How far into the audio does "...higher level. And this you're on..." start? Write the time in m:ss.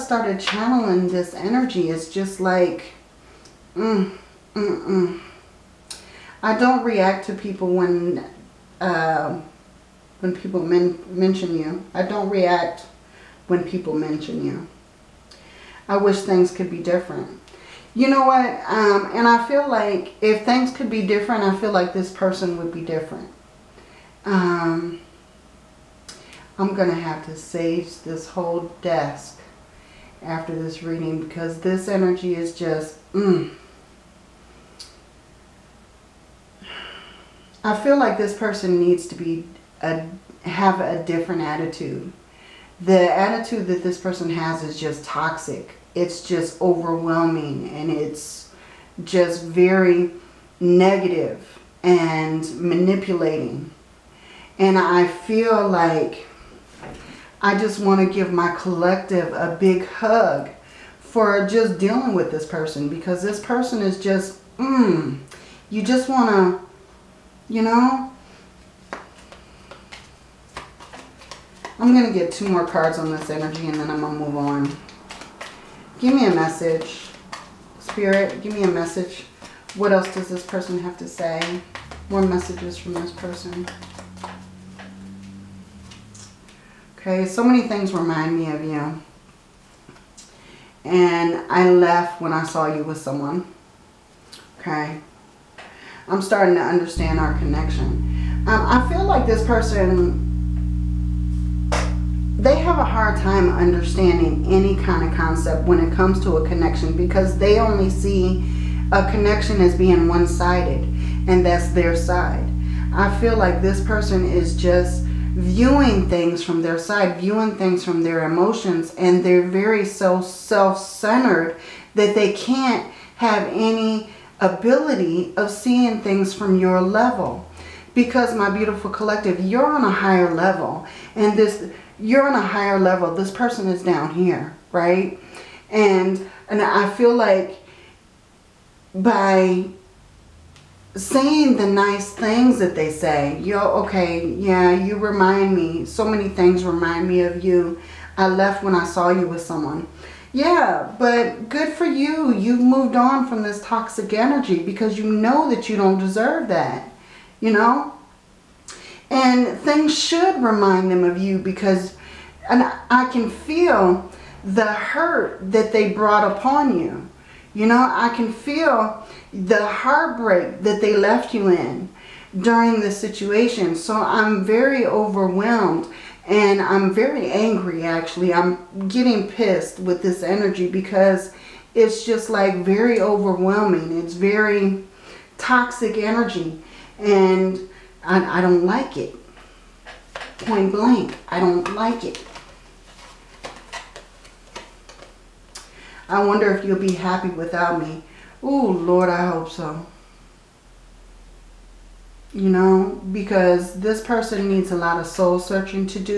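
2:09.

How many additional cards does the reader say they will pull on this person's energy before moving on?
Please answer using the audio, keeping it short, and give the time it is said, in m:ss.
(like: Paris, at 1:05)
2, at 1:12.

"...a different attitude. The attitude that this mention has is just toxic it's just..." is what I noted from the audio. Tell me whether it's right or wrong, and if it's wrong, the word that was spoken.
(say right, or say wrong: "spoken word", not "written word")
wrong: "person", not "mention".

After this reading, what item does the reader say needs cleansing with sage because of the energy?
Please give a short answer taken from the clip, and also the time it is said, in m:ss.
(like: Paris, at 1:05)
desk, at 0:28.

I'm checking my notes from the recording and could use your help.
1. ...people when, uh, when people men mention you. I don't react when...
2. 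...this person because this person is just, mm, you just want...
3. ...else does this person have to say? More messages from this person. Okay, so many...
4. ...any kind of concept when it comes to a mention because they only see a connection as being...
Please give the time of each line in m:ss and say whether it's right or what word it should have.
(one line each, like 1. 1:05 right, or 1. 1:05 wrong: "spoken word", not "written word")
1. 0:07 right
2. 1:02 right
3. 1:19 right
4. 1:44 wrong: "connection", not "mention".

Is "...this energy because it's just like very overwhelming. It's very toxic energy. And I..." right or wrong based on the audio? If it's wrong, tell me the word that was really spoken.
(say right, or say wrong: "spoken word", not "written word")
right.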